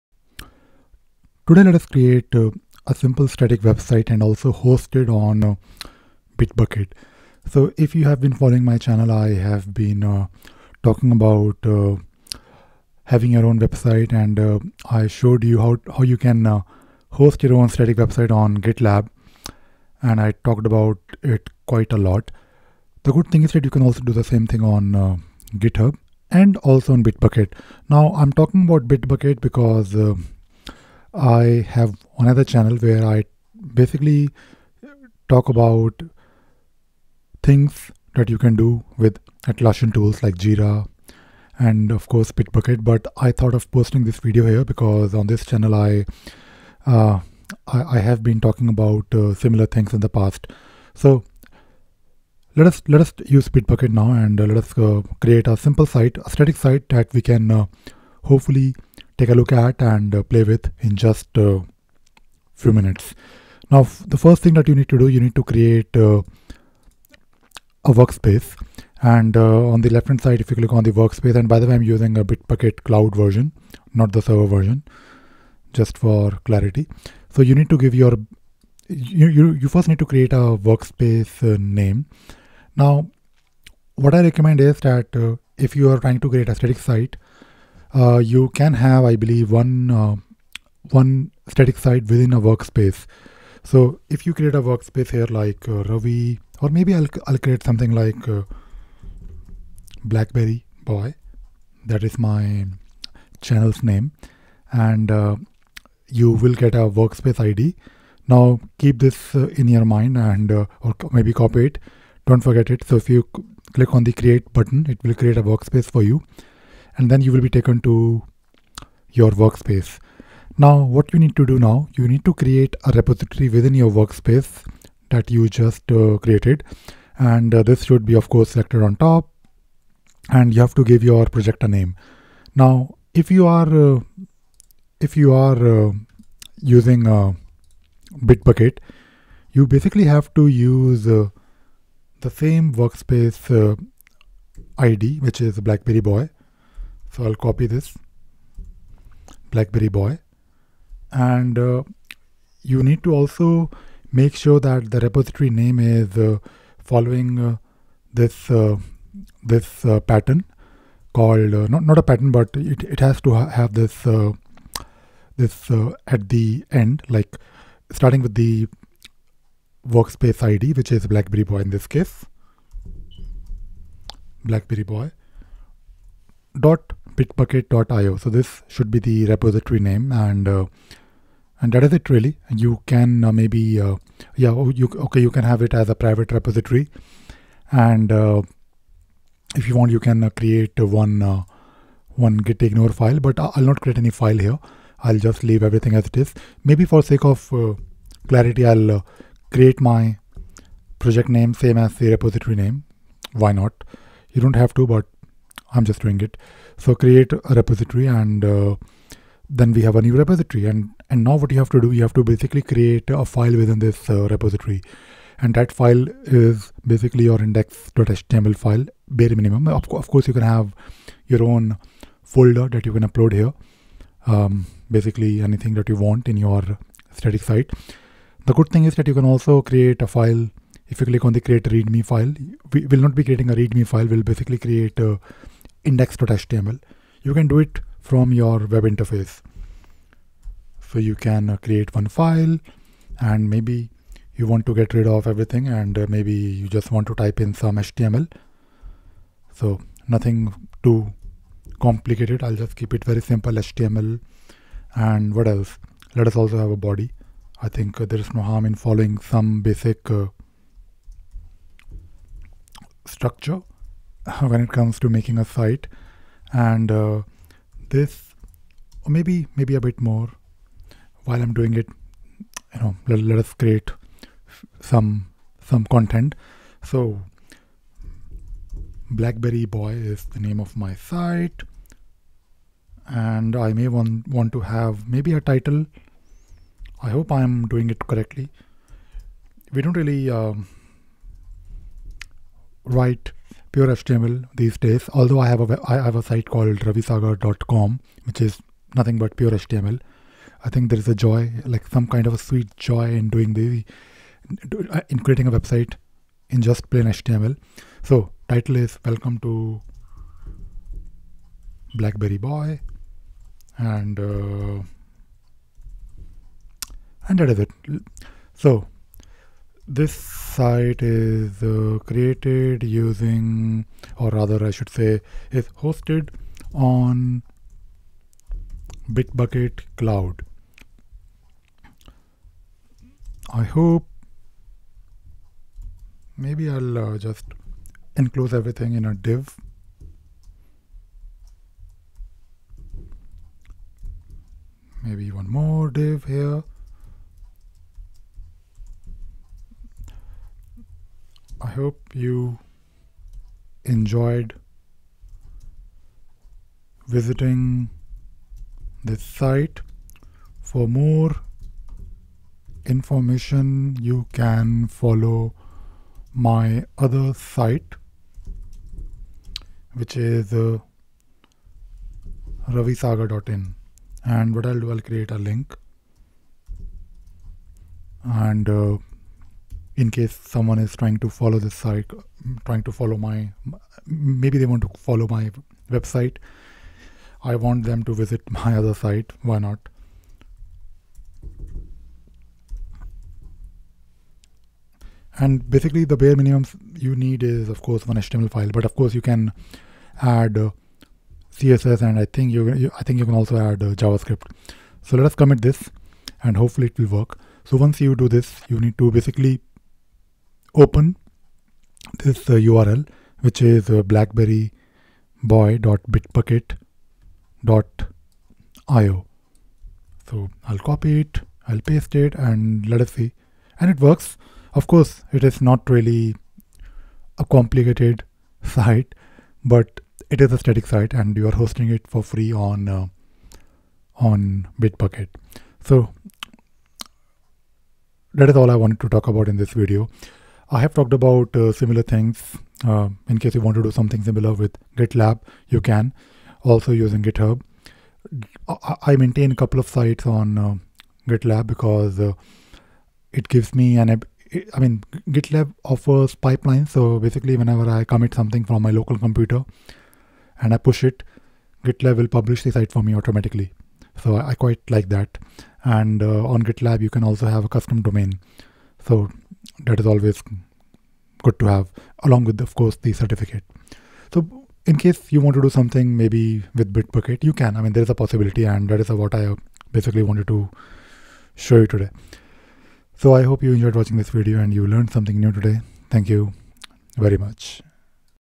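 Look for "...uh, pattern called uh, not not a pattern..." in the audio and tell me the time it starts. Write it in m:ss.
2:39.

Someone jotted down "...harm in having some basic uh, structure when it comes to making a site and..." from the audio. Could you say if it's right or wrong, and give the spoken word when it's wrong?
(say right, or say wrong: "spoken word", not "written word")
wrong: "following", not "having".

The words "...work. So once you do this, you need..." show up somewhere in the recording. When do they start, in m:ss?
6:47.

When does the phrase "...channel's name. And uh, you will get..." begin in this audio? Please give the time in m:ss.
1:43.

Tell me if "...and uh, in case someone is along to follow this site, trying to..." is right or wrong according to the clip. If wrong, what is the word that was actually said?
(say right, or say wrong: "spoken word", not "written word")
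wrong: "trying", not "along".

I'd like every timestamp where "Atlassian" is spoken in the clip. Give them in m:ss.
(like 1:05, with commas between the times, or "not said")
0:39.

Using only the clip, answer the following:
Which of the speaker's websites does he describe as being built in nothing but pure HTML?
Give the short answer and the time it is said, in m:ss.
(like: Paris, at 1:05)
ravisagar.com, at 4:56.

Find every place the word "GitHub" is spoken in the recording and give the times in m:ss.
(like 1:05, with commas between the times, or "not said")
0:25, 7:27.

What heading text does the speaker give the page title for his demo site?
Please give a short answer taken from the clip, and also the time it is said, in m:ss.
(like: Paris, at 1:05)
Welcome to Blackberry Boy, at 5:09.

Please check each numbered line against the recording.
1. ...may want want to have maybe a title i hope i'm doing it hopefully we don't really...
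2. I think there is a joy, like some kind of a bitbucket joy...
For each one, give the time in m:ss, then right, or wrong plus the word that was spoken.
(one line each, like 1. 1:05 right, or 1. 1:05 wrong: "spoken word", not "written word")
1. 4:43 wrong: "correctly", not "hopefully"
2. 5:00 wrong: "sweet", not "bitbucket".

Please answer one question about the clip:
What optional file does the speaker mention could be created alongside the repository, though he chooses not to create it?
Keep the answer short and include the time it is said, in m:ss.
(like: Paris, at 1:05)
git ignore file, at 3:12.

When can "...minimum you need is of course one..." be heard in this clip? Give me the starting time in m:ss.
6:36.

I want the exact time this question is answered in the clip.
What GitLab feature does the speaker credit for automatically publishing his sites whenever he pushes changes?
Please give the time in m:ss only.
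7:36.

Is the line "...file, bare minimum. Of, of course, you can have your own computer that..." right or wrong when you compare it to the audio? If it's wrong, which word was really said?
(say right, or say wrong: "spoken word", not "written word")
wrong: "folder", not "computer".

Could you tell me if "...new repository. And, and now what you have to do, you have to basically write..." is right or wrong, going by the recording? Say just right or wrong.
wrong.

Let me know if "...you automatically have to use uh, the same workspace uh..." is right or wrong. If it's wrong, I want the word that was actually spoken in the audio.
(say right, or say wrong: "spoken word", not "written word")
wrong: "basically", not "automatically".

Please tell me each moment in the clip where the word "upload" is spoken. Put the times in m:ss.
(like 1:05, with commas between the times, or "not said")
3:43.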